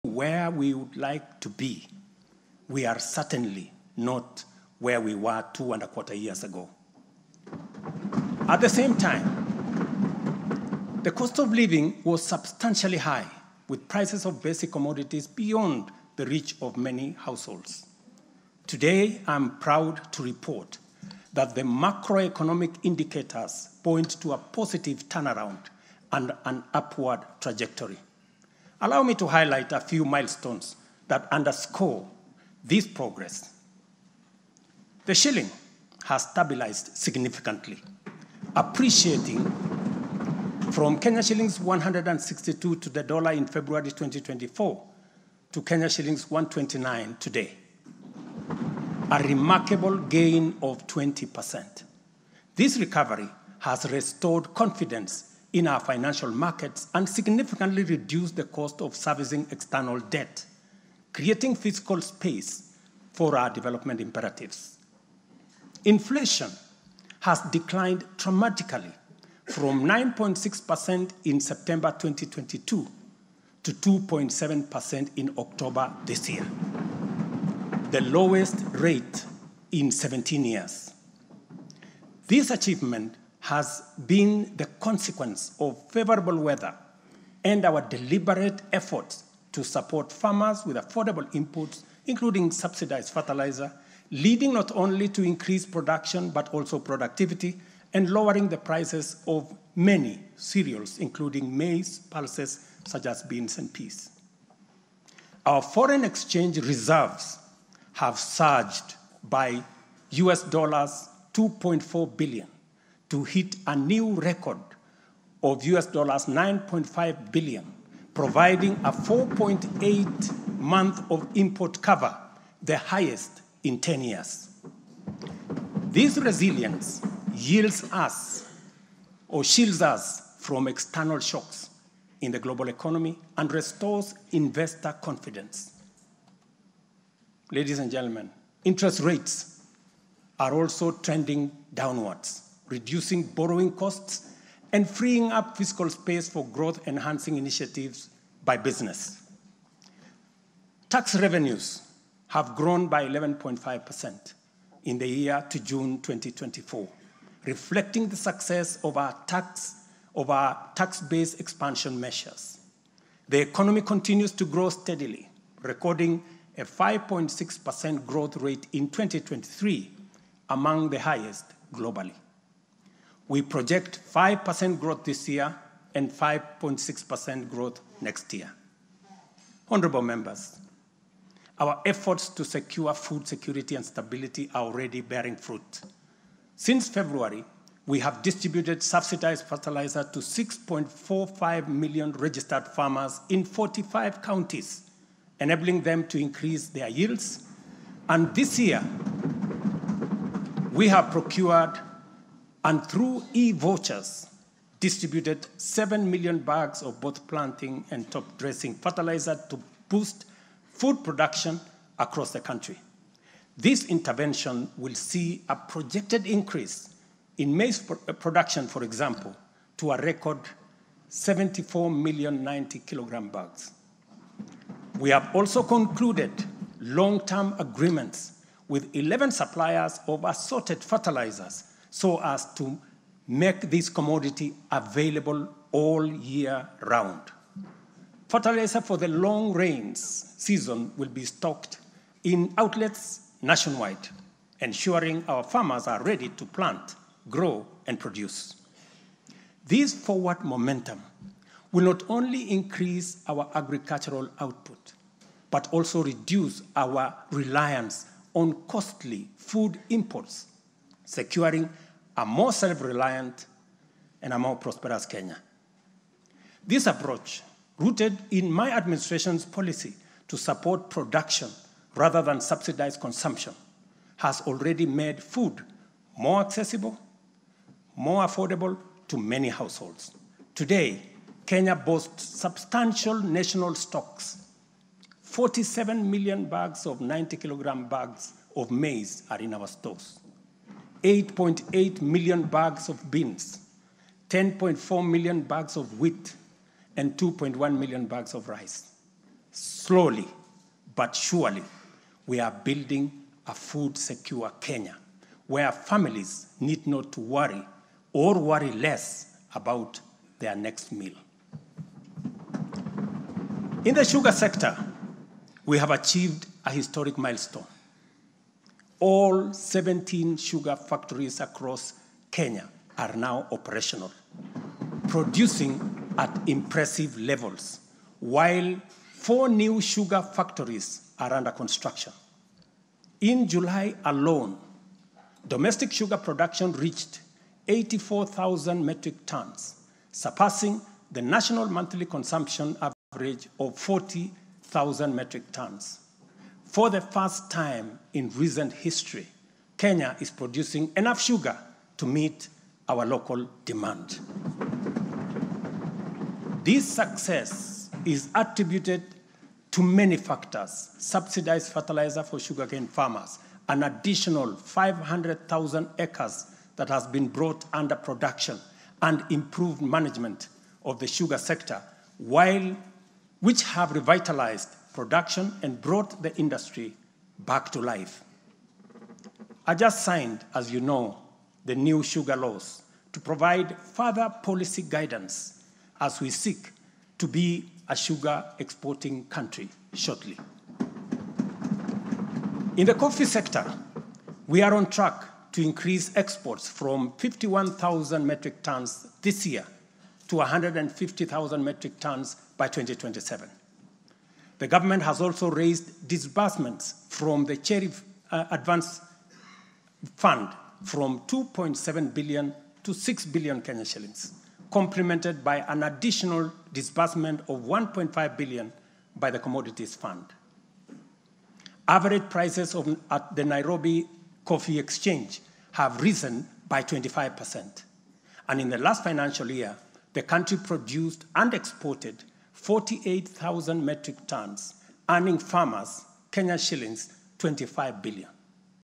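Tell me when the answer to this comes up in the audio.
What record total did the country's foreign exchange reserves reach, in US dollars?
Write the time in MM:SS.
01:56.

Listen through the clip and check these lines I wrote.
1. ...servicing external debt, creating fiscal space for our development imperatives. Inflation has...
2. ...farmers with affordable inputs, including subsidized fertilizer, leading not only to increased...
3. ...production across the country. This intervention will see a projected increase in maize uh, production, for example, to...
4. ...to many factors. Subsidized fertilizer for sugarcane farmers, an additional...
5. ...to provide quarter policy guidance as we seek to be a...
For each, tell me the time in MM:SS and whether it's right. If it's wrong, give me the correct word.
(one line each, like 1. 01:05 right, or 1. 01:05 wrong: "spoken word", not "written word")
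1. 00:58 right
2. 01:30 right
3. 03:31 right
4. 05:59 right
5. 06:23 wrong: "further", not "quarter".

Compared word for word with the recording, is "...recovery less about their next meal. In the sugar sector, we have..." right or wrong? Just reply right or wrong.
wrong.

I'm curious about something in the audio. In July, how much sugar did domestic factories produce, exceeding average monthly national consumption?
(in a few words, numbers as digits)
84,000 metric tons.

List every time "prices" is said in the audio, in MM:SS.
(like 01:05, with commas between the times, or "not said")
00:13, 01:38, 07:02.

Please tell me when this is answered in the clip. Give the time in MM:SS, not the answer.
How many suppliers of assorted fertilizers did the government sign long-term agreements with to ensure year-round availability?
03:48.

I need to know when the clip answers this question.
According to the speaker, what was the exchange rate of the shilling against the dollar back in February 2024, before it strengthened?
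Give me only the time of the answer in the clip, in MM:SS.
00:41.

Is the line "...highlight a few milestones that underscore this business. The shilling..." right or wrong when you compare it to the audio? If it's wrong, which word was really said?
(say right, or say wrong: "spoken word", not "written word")
wrong: "progress", not "business".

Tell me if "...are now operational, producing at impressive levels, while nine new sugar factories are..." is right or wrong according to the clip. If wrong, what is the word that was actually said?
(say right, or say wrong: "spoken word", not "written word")
wrong: "four", not "nine".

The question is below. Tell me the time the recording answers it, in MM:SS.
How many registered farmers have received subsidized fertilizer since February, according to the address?
03:10.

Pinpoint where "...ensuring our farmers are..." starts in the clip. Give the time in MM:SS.
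04:04.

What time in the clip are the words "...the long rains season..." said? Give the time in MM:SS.
03:58.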